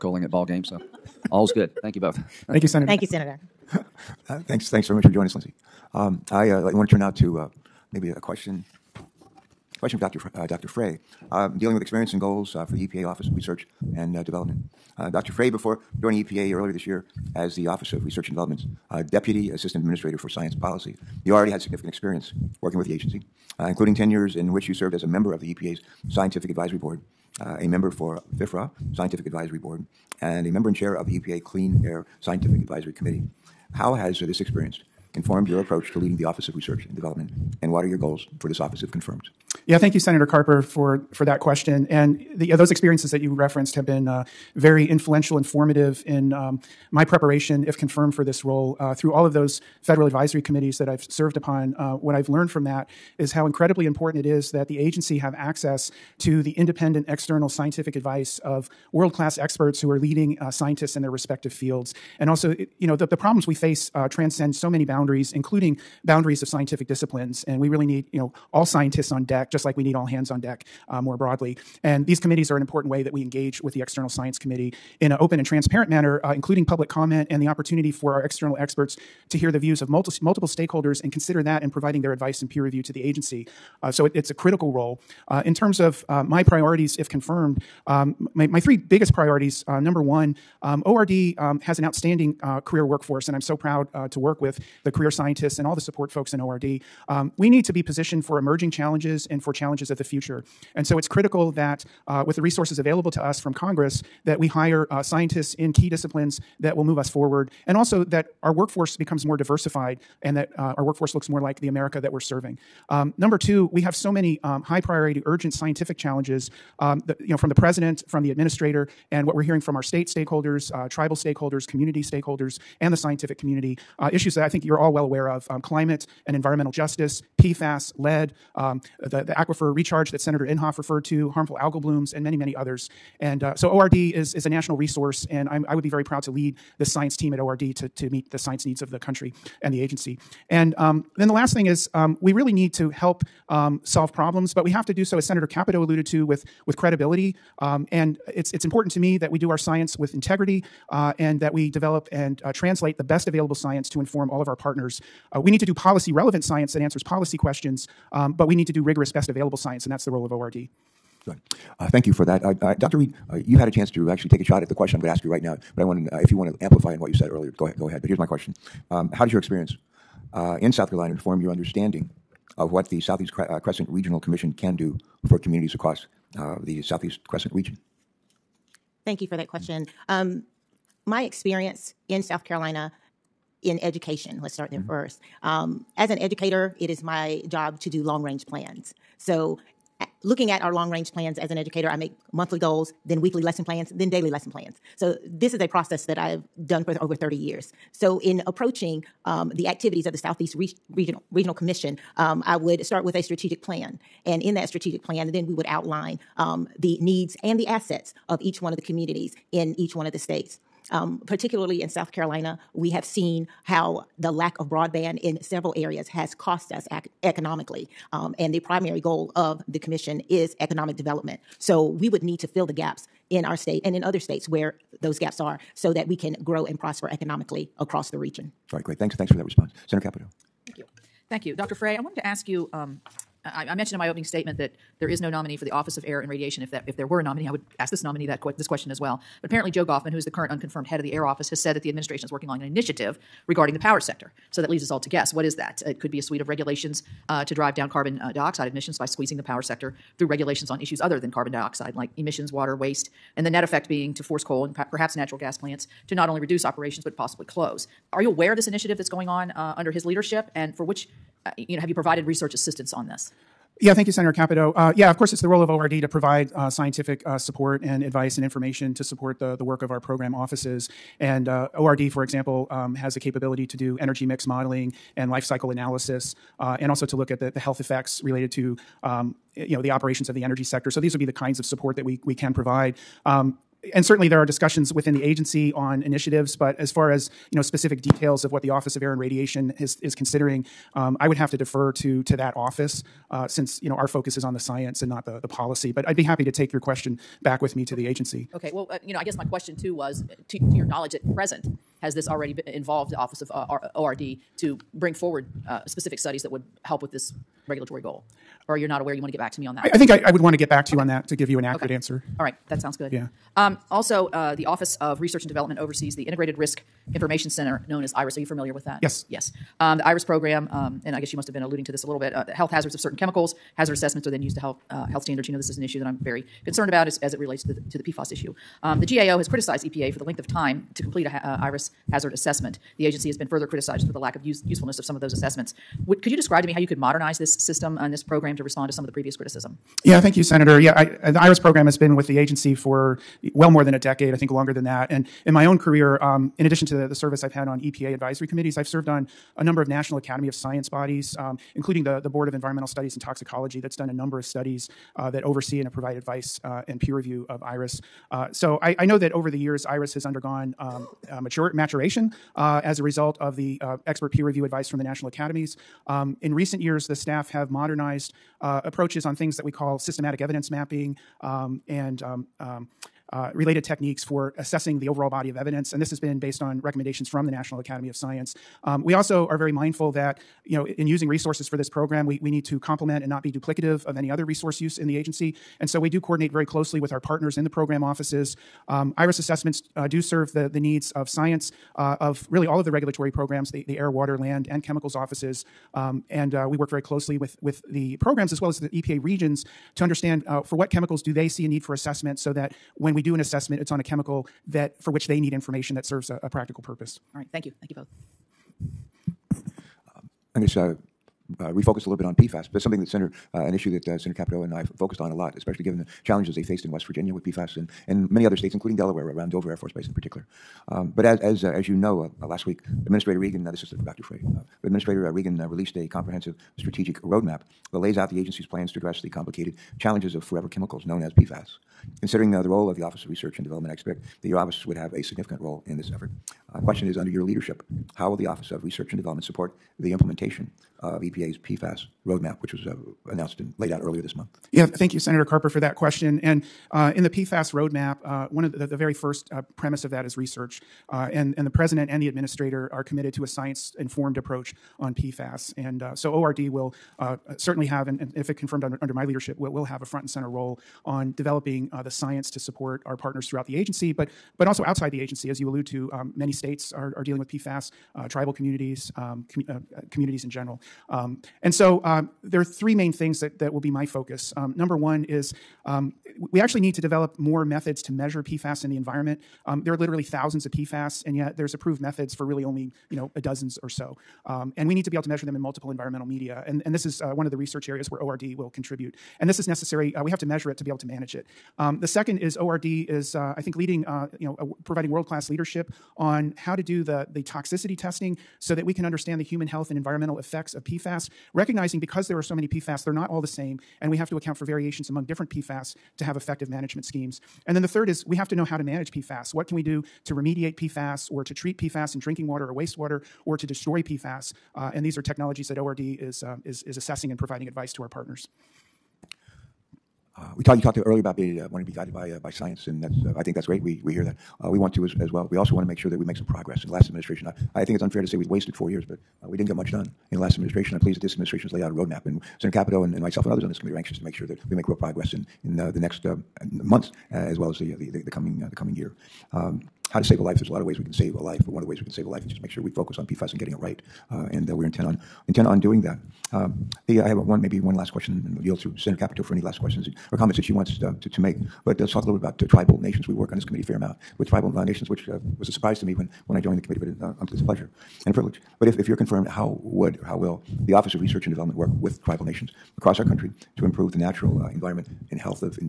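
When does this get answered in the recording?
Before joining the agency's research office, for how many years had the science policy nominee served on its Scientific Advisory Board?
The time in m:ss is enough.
0:23.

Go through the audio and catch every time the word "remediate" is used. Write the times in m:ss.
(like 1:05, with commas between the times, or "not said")
8:30.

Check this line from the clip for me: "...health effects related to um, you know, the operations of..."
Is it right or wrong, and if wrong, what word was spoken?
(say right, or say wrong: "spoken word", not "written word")
right.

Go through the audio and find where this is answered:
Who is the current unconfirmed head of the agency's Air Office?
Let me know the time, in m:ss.
3:59.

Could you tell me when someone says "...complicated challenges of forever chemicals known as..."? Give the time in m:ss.
7:09.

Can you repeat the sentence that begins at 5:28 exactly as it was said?
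Um, the GAO has criticized EPA for the length of time to complete a uh, IRIS hazard assessment.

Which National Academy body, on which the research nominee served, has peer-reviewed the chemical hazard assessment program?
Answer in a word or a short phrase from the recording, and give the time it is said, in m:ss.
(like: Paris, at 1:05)
Board of Environmental Studies and Toxicology, at 5:52.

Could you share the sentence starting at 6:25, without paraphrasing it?
And so we do coordinate very closely with our partners in the program offices.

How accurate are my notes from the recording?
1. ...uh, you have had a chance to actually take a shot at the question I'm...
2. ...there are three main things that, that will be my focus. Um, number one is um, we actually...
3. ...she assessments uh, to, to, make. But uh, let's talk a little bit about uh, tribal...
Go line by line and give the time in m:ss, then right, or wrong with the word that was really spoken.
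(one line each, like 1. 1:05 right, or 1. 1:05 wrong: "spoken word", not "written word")
1. 2:43 right
2. 7:52 right
3. 9:10 wrong: "wants", not "assessments".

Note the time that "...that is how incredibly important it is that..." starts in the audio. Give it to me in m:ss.
0:52.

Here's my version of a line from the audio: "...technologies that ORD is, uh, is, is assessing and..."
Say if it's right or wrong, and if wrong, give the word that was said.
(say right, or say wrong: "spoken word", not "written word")
right.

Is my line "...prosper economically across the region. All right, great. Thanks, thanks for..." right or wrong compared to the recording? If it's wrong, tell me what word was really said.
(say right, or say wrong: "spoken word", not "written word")
right.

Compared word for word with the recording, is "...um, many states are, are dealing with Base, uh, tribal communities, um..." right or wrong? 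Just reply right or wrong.
wrong.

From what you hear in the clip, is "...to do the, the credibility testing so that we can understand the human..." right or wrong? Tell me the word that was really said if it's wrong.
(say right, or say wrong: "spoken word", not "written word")
wrong: "toxicity", not "credibility".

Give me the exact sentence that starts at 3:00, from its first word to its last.
Um, my experience in South Carolina in education, let's start there mm-hmm.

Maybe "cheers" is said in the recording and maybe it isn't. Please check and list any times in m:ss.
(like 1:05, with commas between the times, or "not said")
not said.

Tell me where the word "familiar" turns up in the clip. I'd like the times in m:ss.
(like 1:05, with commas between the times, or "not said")
5:18.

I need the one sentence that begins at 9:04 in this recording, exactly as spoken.
Uh, and uh, we're intent on intent on doing that.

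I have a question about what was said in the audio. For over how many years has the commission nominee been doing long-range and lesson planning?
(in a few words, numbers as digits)
30.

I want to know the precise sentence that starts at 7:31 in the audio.
Uh, and, and the president and the administrator are committed to a science informed approach on PFAS.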